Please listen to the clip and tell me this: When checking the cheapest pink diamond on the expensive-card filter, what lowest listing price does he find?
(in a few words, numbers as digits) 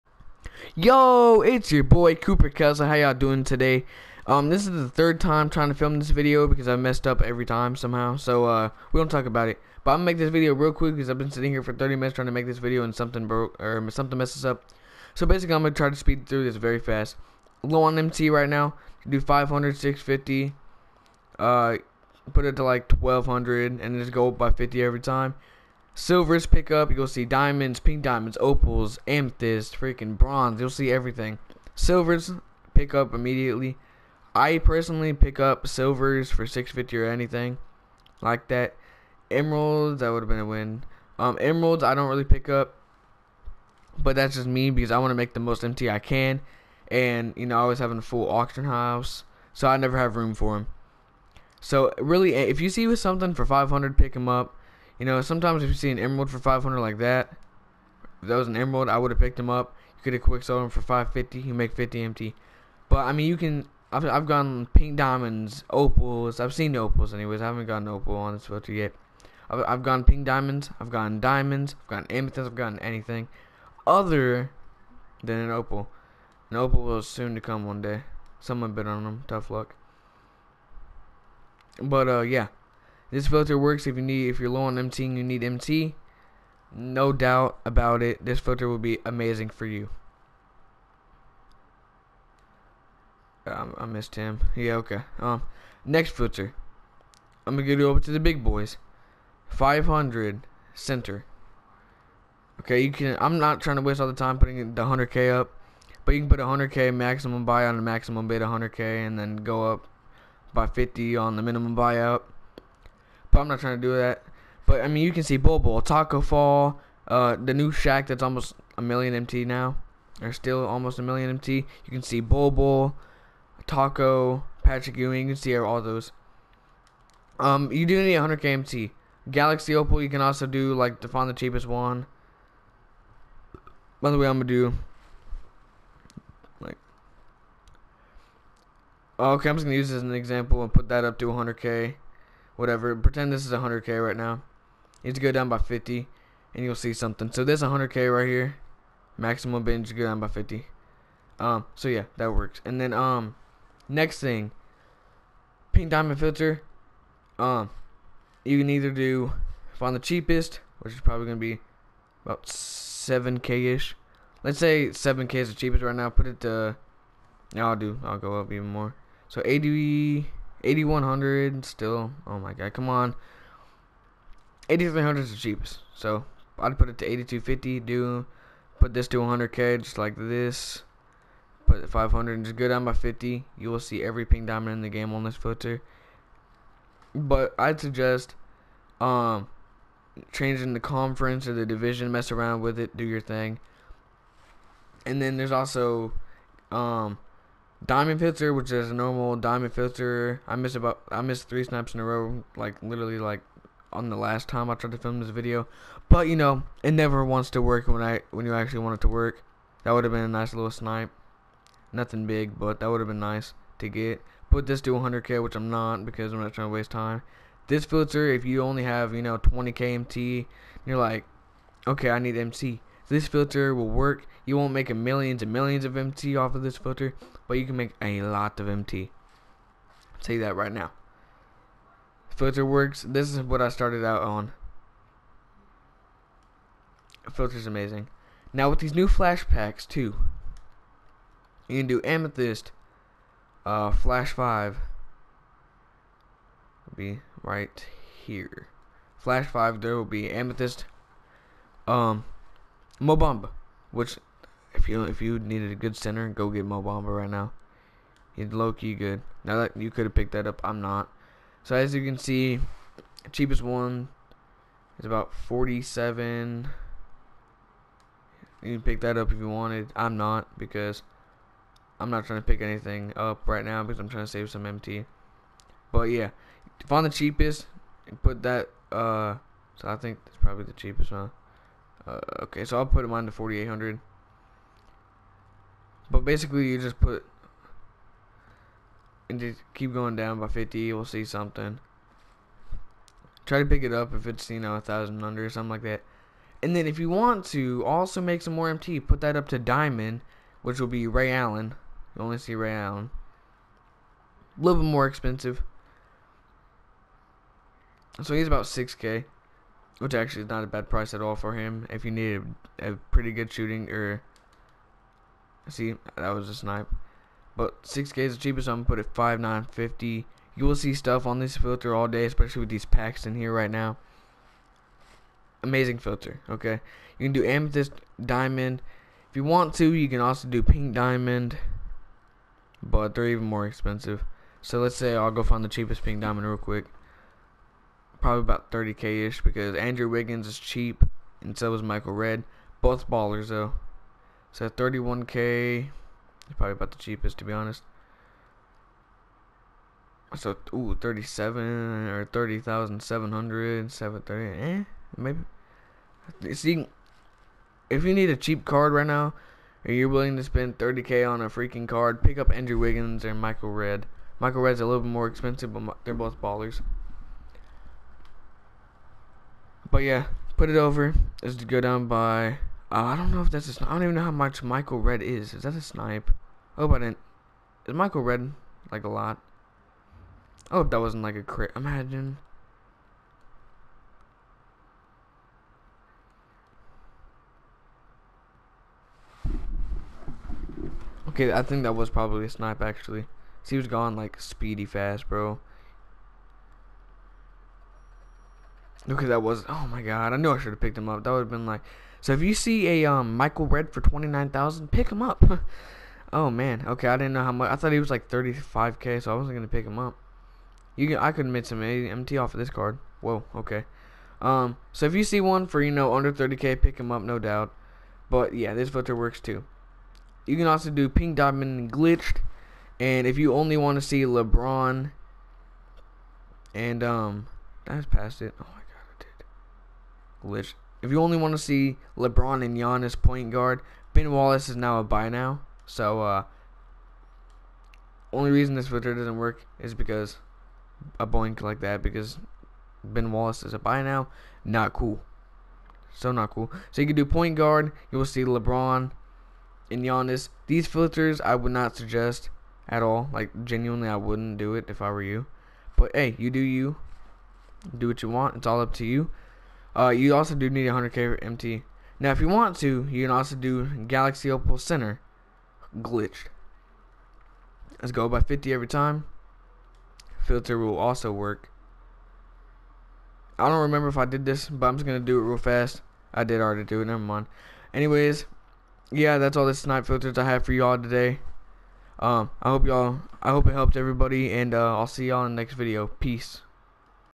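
8300.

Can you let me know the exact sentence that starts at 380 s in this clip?
Oh, that wasn't like a crit.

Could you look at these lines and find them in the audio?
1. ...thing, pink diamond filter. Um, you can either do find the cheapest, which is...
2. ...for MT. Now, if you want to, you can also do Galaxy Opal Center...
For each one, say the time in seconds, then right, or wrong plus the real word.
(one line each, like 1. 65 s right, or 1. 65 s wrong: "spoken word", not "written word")
1. 154 s right
2. 461 s right.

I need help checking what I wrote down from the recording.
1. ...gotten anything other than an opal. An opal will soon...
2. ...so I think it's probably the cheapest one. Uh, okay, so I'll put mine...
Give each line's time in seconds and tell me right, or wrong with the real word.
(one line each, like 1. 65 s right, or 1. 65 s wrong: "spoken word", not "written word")
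1. 72 s right
2. 279 s right.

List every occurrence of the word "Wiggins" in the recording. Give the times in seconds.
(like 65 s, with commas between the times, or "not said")
340 s, 362 s.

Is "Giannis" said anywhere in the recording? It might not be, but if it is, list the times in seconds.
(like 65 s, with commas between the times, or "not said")
432 s, 450 s.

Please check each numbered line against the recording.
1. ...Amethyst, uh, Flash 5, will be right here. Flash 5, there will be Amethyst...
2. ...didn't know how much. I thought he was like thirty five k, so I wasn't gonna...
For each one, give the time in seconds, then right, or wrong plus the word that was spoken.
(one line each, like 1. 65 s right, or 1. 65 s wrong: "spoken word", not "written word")
1. 242 s right
2. 407 s right.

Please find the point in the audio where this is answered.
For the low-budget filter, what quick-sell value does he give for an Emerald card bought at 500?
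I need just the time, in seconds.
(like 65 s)
60 s.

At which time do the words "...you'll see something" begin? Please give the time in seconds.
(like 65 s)
146 s.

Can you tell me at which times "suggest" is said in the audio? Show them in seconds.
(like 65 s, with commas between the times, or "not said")
187 s, 451 s.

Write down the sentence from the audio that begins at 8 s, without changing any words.
So uh, we don't talk about it.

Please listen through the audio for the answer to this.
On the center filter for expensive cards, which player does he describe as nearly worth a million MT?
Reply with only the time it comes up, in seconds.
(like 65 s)
117 s.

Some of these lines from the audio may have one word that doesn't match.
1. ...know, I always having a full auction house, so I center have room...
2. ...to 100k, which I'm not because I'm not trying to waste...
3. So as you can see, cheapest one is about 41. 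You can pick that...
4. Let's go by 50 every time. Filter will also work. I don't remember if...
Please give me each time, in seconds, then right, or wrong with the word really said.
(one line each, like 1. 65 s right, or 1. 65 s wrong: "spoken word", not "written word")
1. 47 s wrong: "never", not "center"
2. 214 s right
3. 261 s wrong: "47", not "41"
4. 468 s right.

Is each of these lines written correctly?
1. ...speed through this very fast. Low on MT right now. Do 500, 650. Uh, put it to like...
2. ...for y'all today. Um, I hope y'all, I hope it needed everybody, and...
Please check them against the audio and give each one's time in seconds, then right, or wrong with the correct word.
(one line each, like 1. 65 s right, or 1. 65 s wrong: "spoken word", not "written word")
1. 15 s right
2. 480 s wrong: "helped", not "needed".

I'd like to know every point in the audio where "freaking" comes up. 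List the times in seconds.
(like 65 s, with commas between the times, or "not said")
29 s, 361 s.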